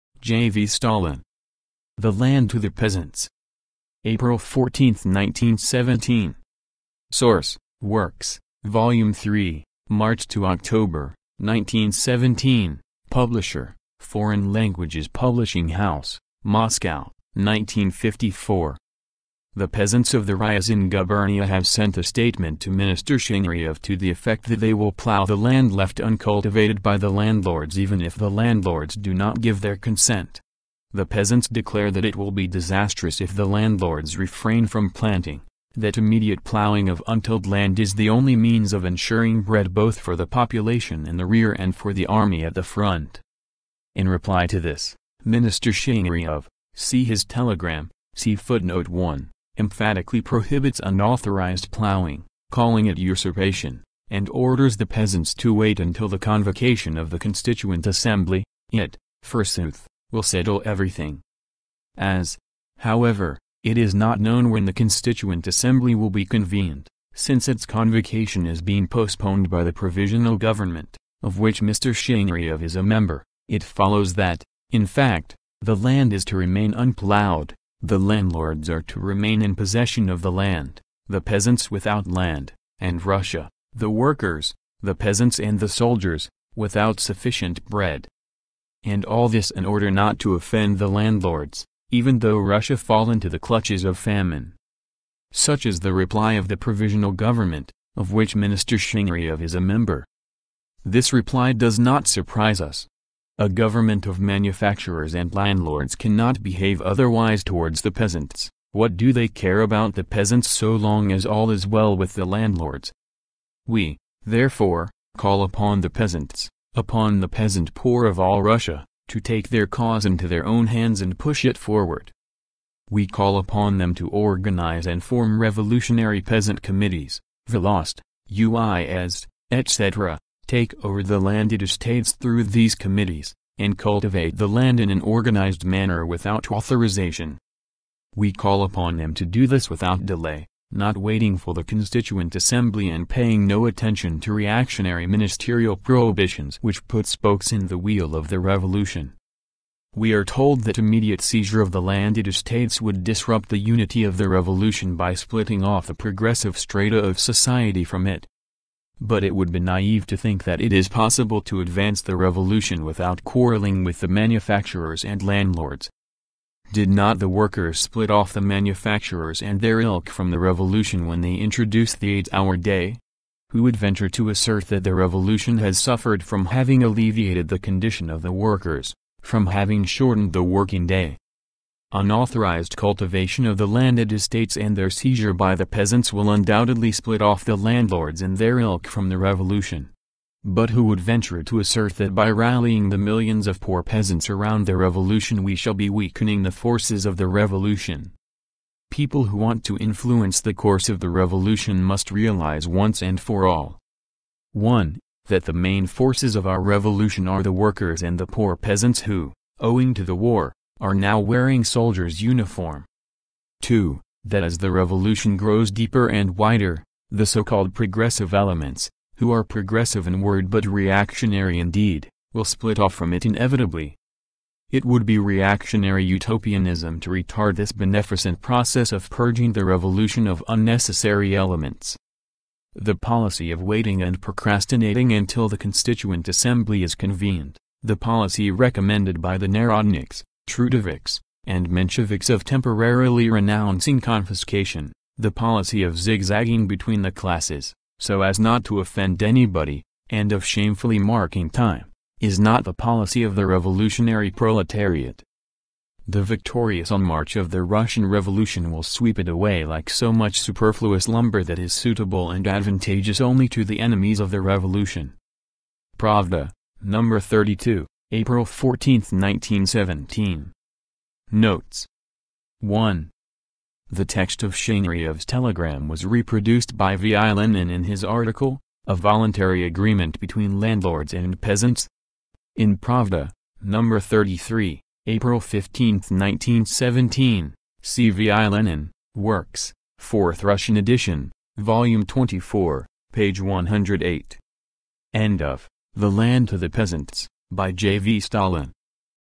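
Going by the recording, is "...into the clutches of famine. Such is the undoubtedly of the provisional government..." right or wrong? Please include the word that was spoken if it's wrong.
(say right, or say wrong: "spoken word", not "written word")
wrong: "reply", not "undoubtedly".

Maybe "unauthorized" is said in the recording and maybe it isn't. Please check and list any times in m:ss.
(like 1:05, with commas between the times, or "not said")
0:50, 3:01.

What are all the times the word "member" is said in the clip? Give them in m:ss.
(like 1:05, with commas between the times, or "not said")
1:12, 1:39.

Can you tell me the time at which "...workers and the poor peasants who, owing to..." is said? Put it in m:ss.
3:27.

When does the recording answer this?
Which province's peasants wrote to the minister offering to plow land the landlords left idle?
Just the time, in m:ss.
0:20.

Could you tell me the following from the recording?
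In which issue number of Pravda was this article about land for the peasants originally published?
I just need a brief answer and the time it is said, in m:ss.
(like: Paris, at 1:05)
32, at 4:26.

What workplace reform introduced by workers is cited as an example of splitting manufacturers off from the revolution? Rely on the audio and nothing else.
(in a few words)
eight-hour day.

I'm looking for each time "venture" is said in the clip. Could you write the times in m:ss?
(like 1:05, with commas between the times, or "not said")
2:53, 3:11.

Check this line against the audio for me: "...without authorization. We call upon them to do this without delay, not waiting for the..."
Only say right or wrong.
right.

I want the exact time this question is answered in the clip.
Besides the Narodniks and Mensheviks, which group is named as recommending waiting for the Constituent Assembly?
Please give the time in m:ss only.
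4:00.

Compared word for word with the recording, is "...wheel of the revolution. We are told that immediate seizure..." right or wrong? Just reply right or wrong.
right.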